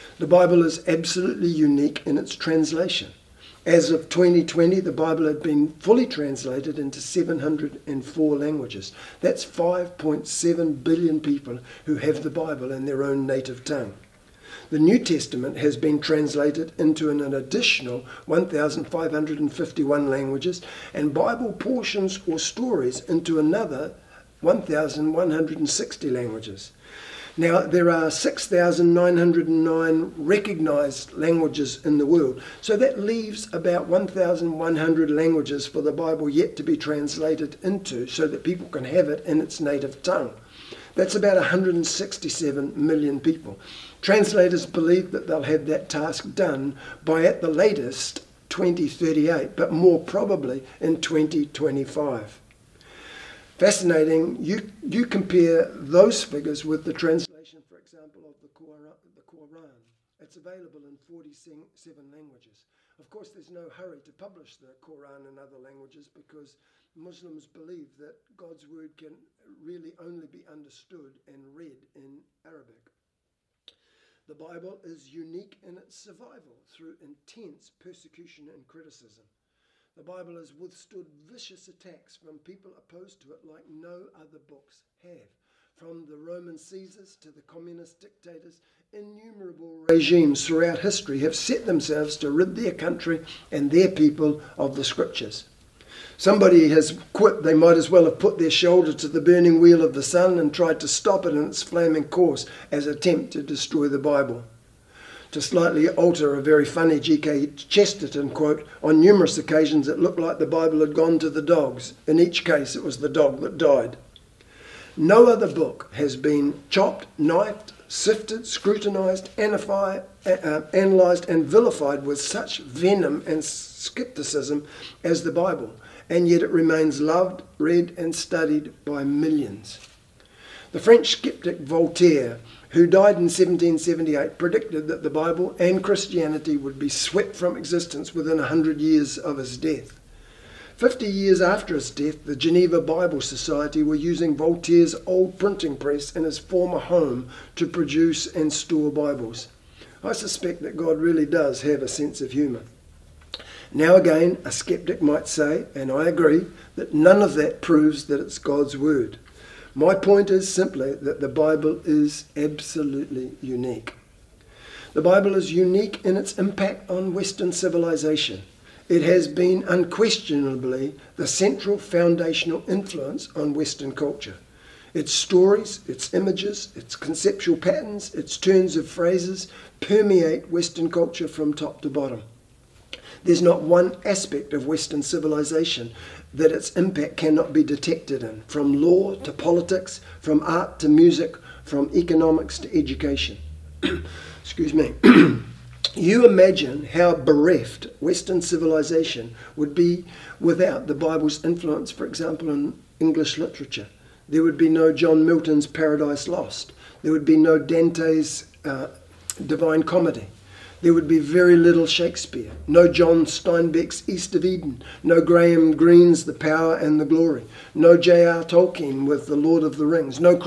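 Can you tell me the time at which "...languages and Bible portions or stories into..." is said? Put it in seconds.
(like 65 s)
20 s.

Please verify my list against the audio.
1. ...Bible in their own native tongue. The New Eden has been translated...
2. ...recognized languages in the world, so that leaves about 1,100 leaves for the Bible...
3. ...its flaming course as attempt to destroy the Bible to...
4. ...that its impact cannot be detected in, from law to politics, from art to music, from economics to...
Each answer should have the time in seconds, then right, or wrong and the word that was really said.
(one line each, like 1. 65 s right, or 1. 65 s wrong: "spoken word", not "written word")
1. 12 s wrong: "Testament", not "Eden"
2. 30 s wrong: "languages", not "leaves"
3. 101 s right
4. 186 s right.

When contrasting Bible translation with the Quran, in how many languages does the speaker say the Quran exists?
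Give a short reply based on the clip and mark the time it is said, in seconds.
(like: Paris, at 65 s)
47, at 60 s.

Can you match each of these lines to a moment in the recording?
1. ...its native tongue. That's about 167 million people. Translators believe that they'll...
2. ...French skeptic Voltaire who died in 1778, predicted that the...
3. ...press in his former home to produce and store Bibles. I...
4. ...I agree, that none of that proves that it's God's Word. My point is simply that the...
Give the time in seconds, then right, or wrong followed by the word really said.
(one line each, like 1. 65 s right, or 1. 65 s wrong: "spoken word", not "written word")
1. 39 s right
2. 130 s right
3. 145 s right
4. 155 s right.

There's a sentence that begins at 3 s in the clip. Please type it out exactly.
As of 2020, the Bible had been fully translated into 704 languages.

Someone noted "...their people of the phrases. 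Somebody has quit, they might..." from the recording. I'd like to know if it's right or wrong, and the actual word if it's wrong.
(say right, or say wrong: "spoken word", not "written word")
wrong: "scriptures", not "phrases".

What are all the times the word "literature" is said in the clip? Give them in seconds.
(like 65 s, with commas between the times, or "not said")
203 s.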